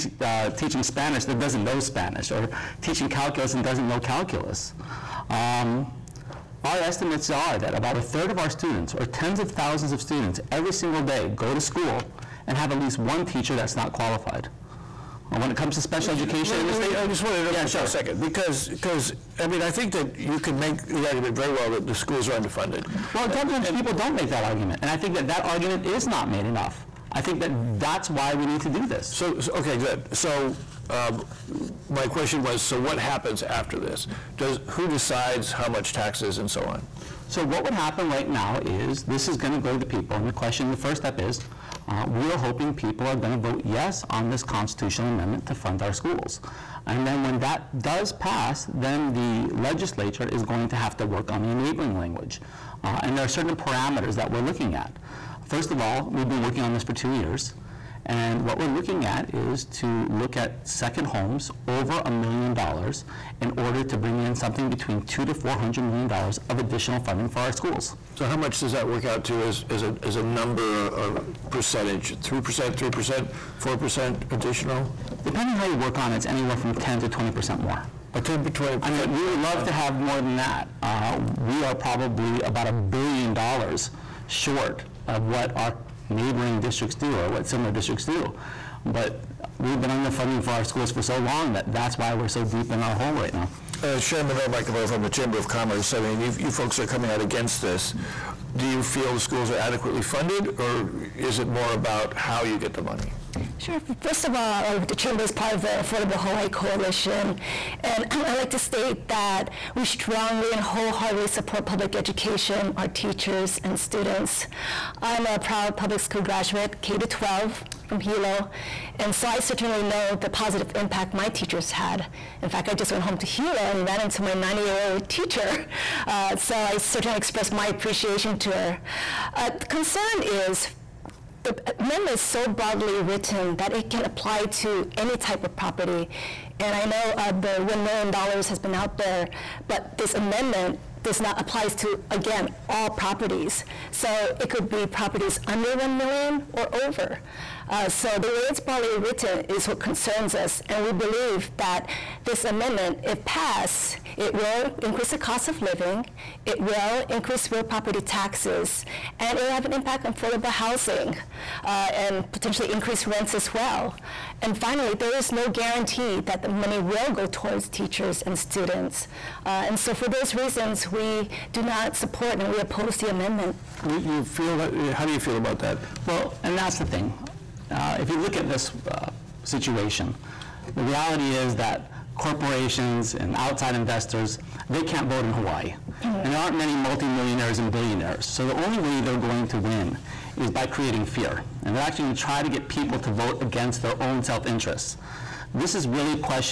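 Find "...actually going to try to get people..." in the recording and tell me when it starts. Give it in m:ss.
3:11.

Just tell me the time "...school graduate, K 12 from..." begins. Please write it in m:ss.
1:56.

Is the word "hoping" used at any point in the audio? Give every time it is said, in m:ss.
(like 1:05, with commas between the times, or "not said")
0:42.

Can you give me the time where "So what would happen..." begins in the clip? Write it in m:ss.
0:37.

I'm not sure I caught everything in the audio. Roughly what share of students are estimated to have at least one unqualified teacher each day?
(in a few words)
a third.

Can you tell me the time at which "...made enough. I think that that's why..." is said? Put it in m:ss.
0:26.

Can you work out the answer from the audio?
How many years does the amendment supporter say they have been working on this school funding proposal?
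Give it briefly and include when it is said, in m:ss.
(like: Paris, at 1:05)
2 years, at 0:56.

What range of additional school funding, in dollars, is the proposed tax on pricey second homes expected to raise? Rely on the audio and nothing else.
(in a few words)
$200 to $400 million.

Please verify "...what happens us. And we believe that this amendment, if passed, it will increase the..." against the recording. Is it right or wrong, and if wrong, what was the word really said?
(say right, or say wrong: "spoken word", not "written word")
wrong: "concerns", not "happens".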